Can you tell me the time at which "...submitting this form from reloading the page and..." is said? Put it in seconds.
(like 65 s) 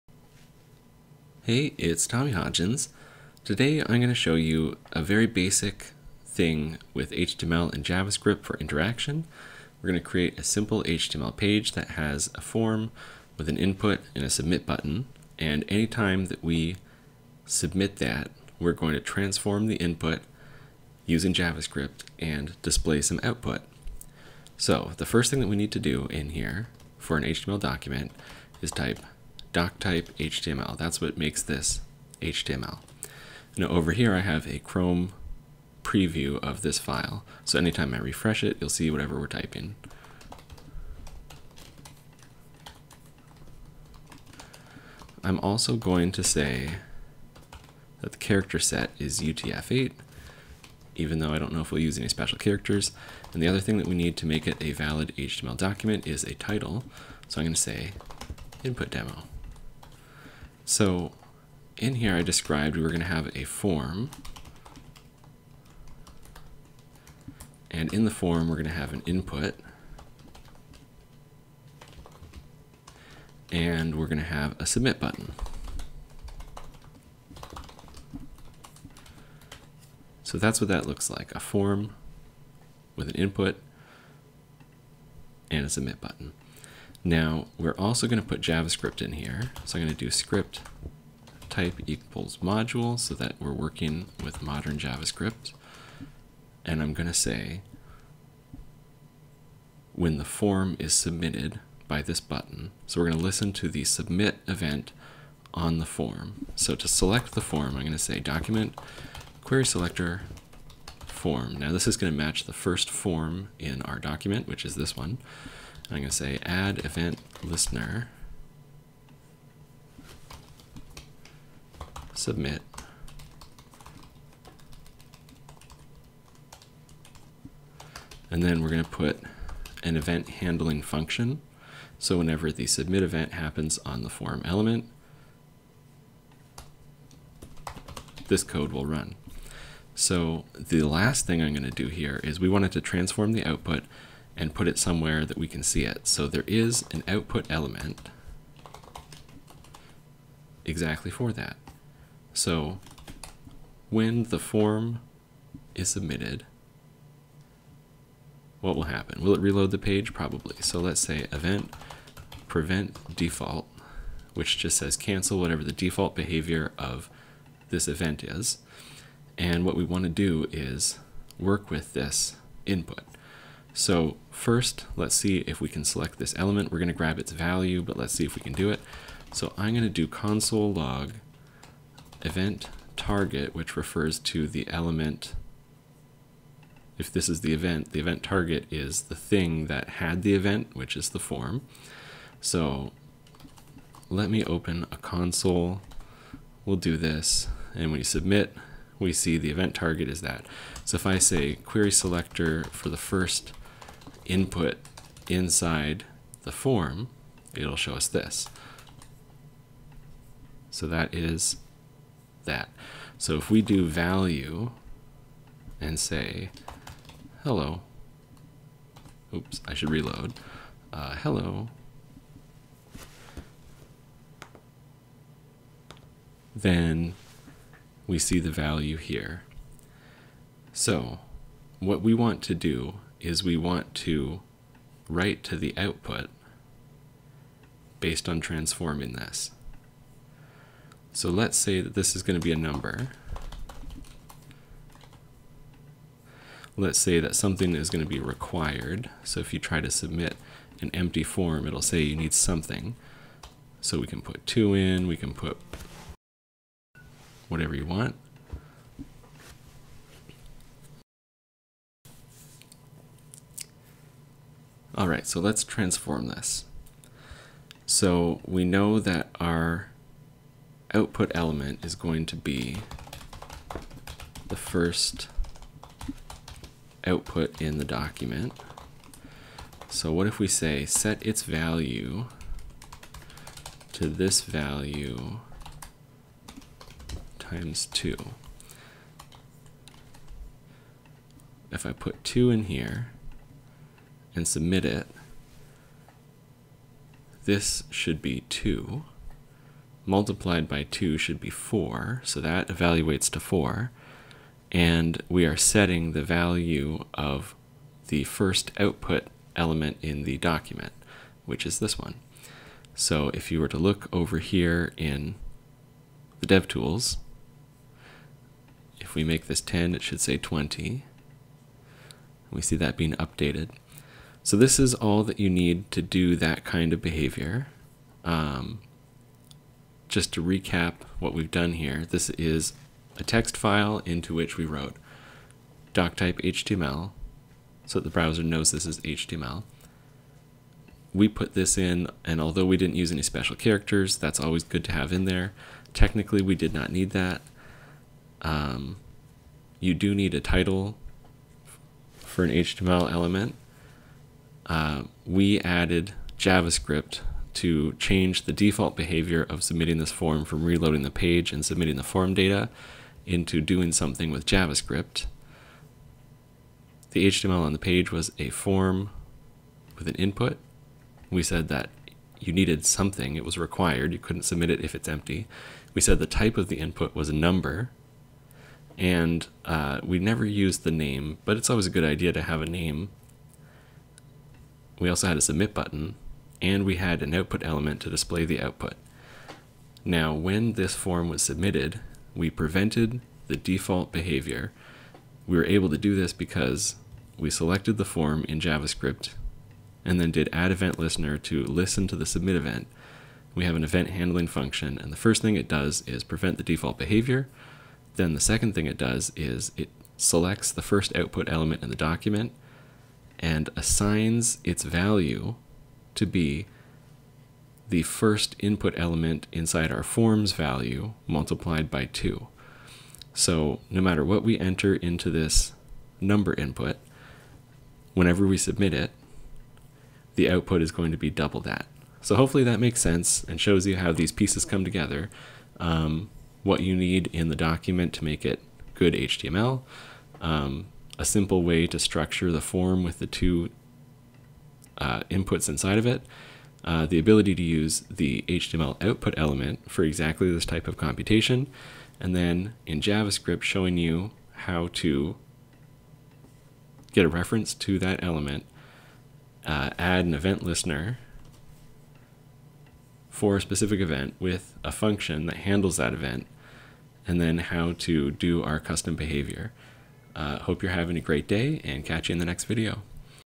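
359 s.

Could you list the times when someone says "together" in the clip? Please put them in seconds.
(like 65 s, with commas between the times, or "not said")
434 s.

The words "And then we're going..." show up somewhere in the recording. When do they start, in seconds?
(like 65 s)
128 s.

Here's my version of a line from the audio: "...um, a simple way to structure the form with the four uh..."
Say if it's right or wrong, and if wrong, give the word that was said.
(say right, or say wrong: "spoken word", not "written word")
wrong: "two", not "four".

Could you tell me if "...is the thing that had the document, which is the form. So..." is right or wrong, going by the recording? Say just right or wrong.
wrong.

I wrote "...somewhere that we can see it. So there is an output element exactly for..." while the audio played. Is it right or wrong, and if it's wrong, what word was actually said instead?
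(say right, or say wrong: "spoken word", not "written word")
right.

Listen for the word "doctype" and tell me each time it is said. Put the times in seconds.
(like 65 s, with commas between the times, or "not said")
335 s.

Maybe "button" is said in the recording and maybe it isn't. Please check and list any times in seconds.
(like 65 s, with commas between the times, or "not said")
14 s, 74 s, 85 s, 102 s, 385 s.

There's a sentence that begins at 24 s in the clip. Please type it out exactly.
So the first thing that we need to do in here for an HTML document is type doc type HTML.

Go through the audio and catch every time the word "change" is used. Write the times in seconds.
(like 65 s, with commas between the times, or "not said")
357 s.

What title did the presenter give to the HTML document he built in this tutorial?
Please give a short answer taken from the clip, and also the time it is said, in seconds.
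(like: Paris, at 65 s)
input demo, at 58 s.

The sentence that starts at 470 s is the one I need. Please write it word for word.
Uh, hope you're having a great day and catch you in the next video.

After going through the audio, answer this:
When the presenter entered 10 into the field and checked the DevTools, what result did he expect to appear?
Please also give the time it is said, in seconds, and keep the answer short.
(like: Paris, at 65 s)
20, at 320 s.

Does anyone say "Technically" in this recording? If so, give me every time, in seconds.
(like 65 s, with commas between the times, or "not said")
345 s.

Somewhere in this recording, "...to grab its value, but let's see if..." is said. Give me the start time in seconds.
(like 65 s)
176 s.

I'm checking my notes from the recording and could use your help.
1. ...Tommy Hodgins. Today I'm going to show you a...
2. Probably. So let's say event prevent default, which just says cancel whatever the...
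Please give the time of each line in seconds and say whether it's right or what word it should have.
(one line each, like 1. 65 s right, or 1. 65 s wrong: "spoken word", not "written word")
1. 2 s right
2. 160 s right.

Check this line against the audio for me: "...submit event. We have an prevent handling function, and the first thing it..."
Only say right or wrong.
wrong.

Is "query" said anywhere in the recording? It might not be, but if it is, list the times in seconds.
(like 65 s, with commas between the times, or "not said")
109 s, 201 s.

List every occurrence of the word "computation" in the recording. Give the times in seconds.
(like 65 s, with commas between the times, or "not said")
450 s.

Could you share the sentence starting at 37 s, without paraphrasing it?
So anytime I refresh it, you'll see whatever we're typing.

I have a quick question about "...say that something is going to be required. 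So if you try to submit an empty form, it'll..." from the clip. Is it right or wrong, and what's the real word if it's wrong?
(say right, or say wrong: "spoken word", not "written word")
right.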